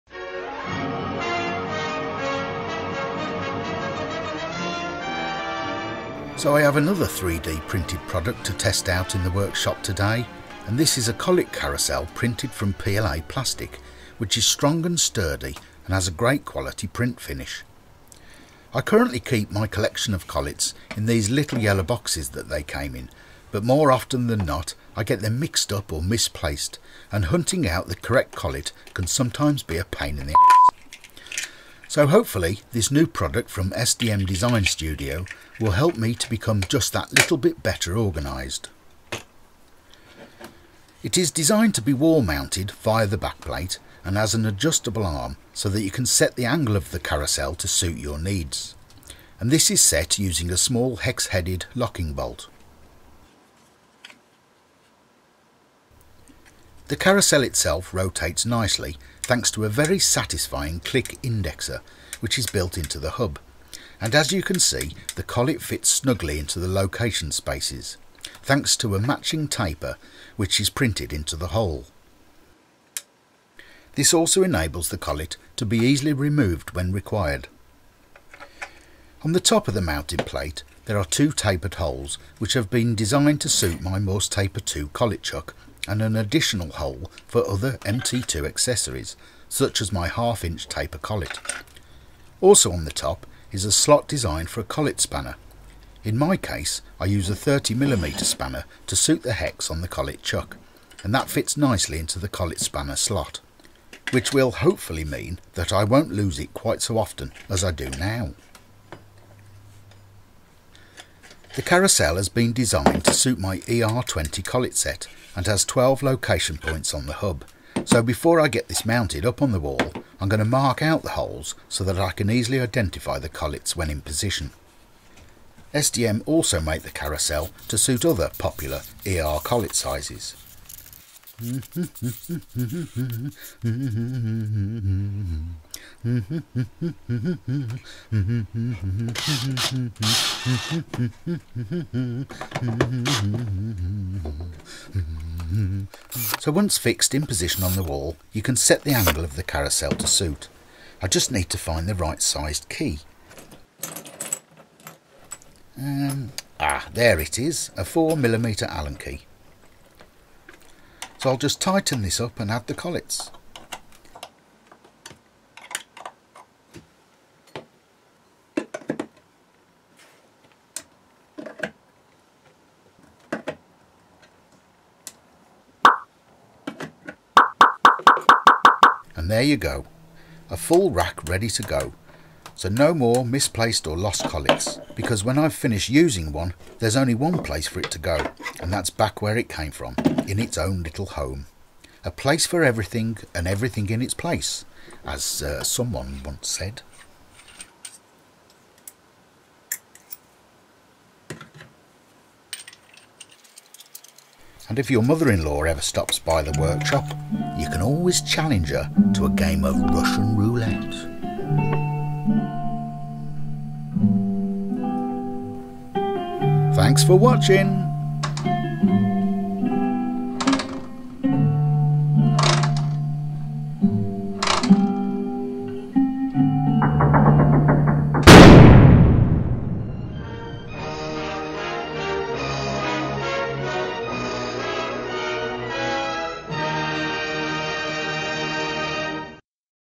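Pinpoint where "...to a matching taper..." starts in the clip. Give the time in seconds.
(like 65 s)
68 s.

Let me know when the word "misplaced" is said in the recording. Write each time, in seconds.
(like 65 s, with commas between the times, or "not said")
26 s, 183 s.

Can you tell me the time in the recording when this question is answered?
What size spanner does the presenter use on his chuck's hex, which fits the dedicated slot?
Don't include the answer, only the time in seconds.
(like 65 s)
97 s.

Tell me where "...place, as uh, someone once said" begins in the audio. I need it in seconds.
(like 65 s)
194 s.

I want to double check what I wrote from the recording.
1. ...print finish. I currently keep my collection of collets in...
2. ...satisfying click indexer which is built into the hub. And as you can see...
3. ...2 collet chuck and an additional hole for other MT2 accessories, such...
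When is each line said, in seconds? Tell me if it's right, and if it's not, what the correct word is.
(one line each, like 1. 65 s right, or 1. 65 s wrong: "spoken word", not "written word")
1. 16 s right
2. 59 s right
3. 84 s right.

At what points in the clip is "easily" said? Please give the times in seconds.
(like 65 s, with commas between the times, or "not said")
75 s, 122 s.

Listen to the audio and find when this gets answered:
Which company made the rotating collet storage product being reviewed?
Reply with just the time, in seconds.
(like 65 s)
33 s.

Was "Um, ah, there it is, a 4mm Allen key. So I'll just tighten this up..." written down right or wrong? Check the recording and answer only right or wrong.
right.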